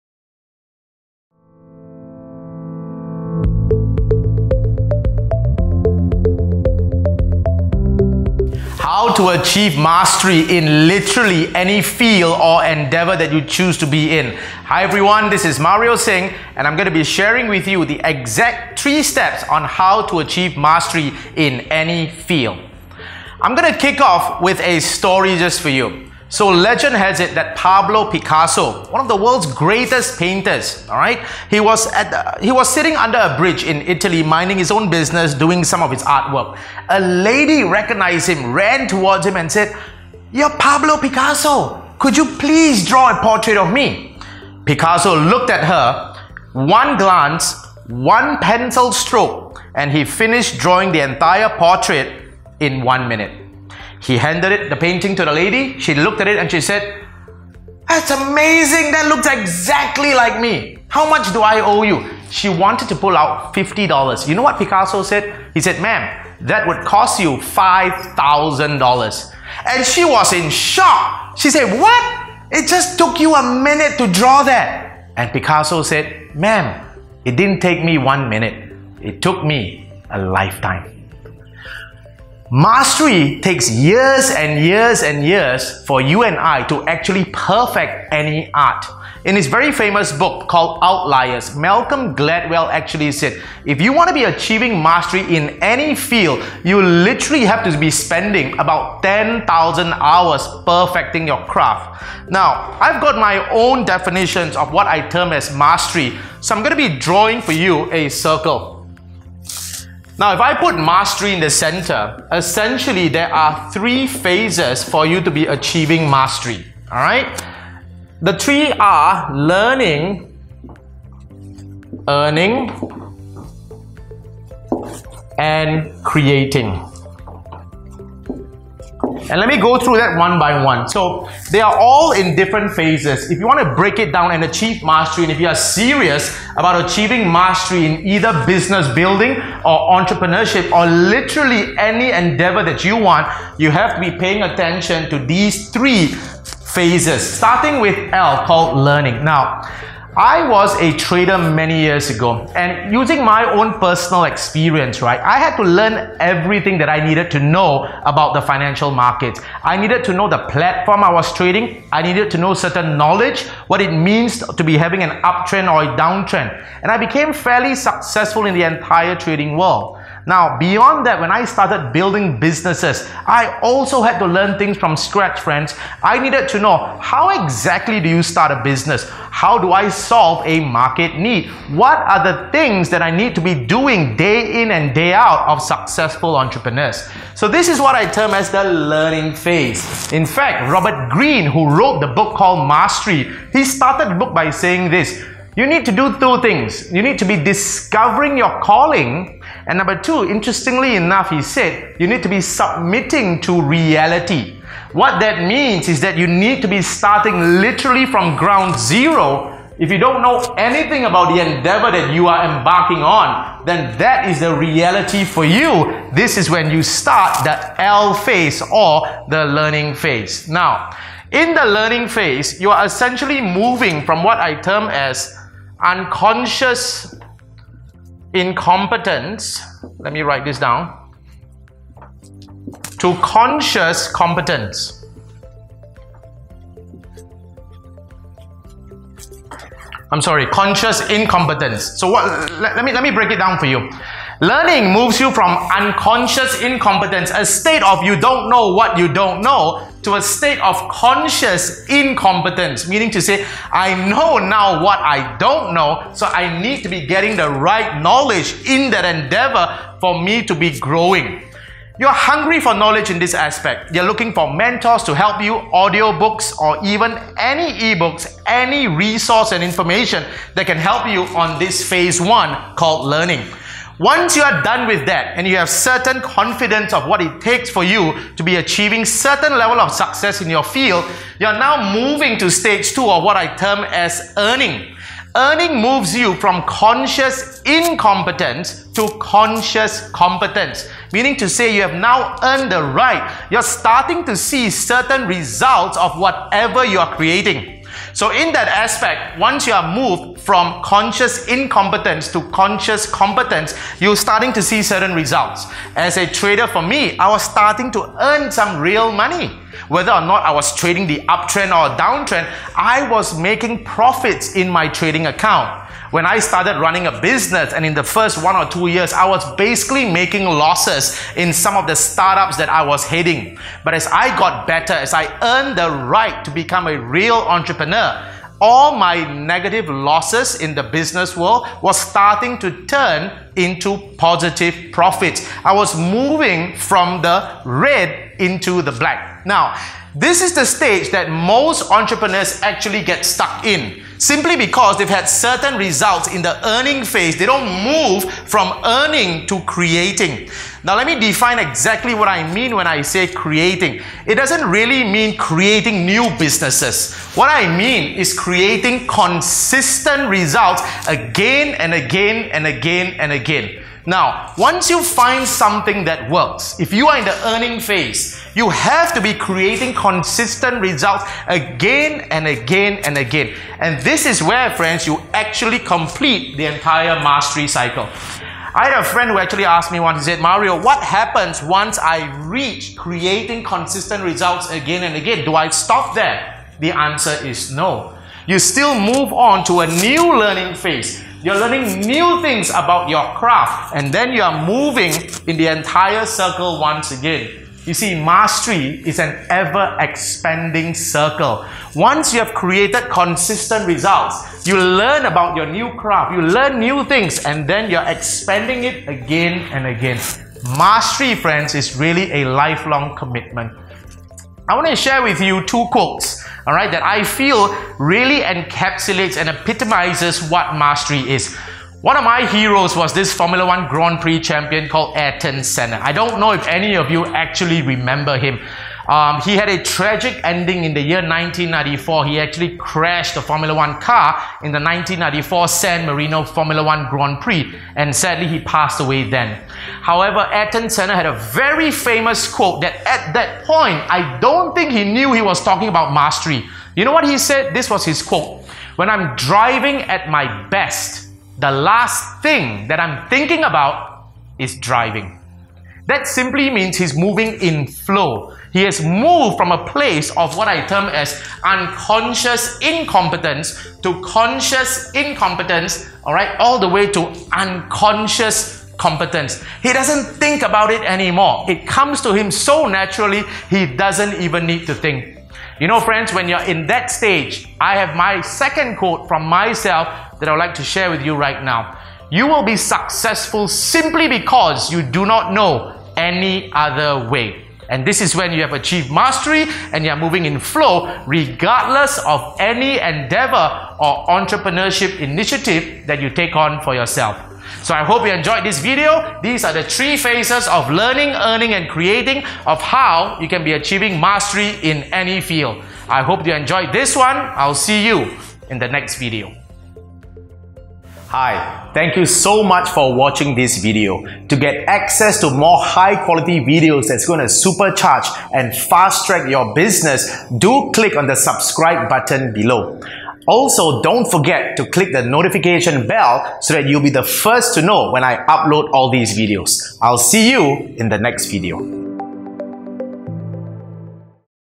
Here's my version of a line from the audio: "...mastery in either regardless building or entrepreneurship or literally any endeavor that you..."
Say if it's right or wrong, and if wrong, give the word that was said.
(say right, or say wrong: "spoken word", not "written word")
wrong: "business", not "regardless".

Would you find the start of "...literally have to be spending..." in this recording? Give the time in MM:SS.
01:36.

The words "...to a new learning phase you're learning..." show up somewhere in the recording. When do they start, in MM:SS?
06:29.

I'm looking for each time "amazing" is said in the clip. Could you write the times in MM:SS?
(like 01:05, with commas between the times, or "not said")
00:58.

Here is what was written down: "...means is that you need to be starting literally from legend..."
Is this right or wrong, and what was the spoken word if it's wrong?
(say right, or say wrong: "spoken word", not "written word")
wrong: "ground", not "legend".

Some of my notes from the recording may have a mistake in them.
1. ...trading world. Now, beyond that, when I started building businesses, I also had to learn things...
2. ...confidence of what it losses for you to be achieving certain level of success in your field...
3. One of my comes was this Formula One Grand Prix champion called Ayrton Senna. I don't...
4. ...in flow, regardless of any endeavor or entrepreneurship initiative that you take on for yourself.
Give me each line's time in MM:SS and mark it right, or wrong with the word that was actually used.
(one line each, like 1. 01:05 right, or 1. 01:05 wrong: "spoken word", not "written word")
1. 02:49 right
2. 04:36 wrong: "takes", not "losses"
3. 07:02 wrong: "heroes", not "comes"
4. 08:10 right.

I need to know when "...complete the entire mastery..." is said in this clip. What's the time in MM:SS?
06:15.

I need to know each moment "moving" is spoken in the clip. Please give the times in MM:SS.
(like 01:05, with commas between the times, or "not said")
03:43, 04:41, 05:35, 06:34, 07:37, 08:10.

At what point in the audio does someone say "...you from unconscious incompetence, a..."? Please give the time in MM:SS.
04:05.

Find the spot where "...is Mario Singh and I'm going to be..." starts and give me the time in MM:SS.
00:15.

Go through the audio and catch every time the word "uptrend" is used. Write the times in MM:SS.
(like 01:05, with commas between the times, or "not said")
02:45, 05:11.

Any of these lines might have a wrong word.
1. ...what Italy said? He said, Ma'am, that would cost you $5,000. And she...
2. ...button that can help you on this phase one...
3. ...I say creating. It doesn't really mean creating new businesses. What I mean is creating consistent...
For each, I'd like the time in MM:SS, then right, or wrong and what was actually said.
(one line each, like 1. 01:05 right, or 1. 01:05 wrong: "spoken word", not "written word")
1. 01:04 wrong: "Picasso", not "Italy"
2. 04:29 wrong: "information", not "button"
3. 05:52 right.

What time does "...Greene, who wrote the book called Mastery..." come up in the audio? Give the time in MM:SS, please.
03:11.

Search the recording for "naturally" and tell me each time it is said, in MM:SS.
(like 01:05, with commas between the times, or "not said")
07:52.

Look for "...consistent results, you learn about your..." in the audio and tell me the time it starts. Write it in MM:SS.
06:43.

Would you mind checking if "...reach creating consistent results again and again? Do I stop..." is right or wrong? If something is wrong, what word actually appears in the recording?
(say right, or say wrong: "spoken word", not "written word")
right.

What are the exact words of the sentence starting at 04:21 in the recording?
You're hungry for knowledge in this aspect.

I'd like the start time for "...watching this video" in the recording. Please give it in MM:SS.
08:33.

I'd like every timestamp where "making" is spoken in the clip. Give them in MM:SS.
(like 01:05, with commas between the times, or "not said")
05:13, 05:20.